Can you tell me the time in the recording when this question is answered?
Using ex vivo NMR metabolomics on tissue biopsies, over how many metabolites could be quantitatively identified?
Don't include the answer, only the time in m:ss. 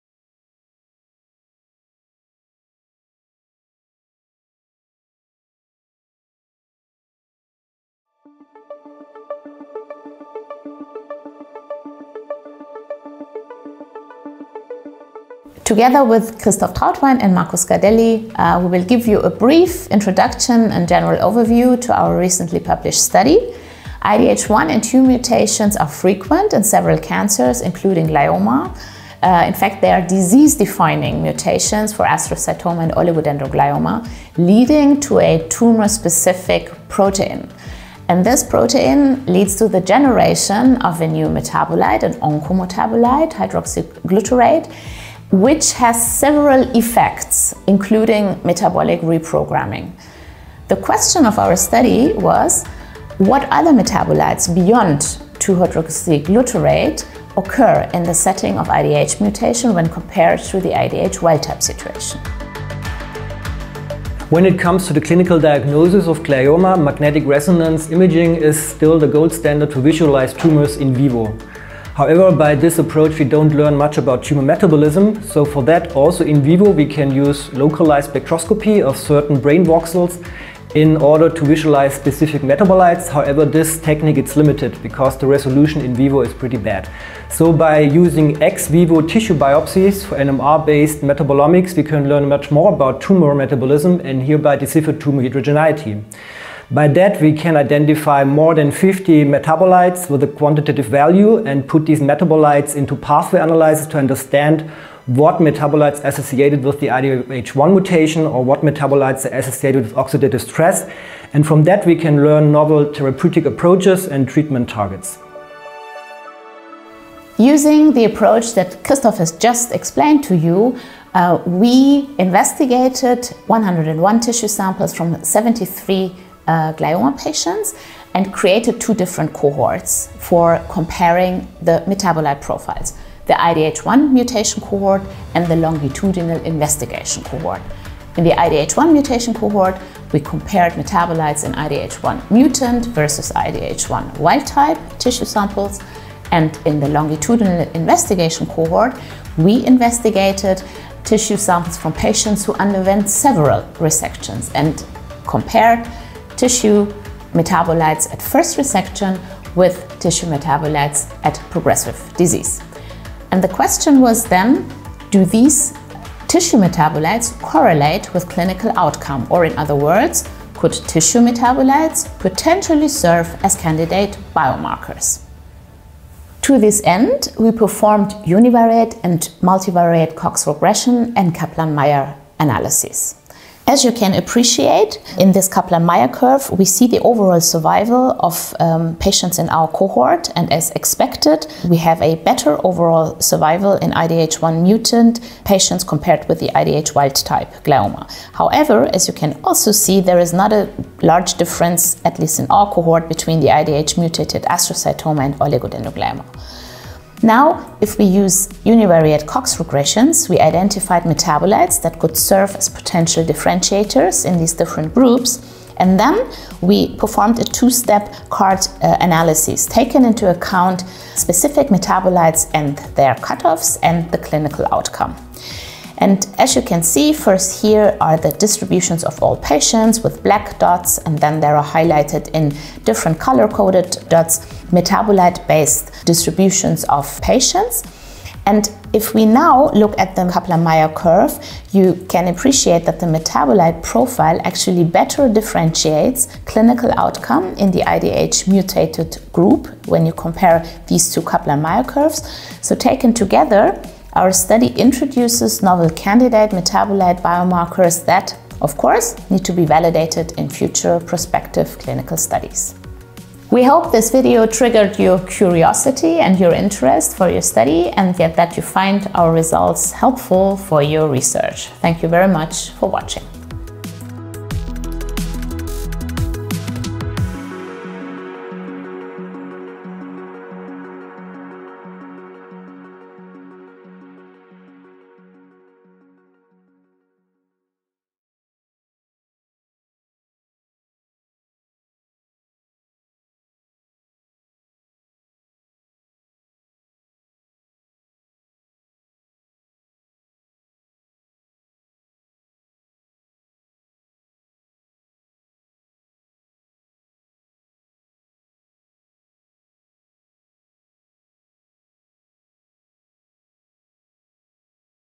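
1:38.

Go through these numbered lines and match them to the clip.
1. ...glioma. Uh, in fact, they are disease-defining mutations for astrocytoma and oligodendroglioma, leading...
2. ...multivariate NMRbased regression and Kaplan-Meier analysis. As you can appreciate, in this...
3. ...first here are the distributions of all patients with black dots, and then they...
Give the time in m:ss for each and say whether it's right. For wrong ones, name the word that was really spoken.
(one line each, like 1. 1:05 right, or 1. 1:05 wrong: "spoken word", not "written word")
1. 0:28 right
2. 2:59 wrong: "Cox", not "NMRbased"
3. 3:47 right.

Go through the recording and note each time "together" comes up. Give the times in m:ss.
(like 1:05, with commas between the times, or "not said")
0:15, 4:13.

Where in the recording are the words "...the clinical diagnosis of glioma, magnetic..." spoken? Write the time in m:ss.
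1:04.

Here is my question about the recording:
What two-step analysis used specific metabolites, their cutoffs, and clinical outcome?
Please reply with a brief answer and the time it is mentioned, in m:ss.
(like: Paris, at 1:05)
CART, at 3:38.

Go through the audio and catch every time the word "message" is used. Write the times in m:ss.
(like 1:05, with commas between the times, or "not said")
not said.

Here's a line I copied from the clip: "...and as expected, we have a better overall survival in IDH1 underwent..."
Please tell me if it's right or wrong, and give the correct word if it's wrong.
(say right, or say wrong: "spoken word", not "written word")
wrong: "mutant", not "underwent".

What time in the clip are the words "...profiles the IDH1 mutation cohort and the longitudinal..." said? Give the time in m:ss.
2:12.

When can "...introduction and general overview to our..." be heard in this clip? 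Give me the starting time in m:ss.
0:19.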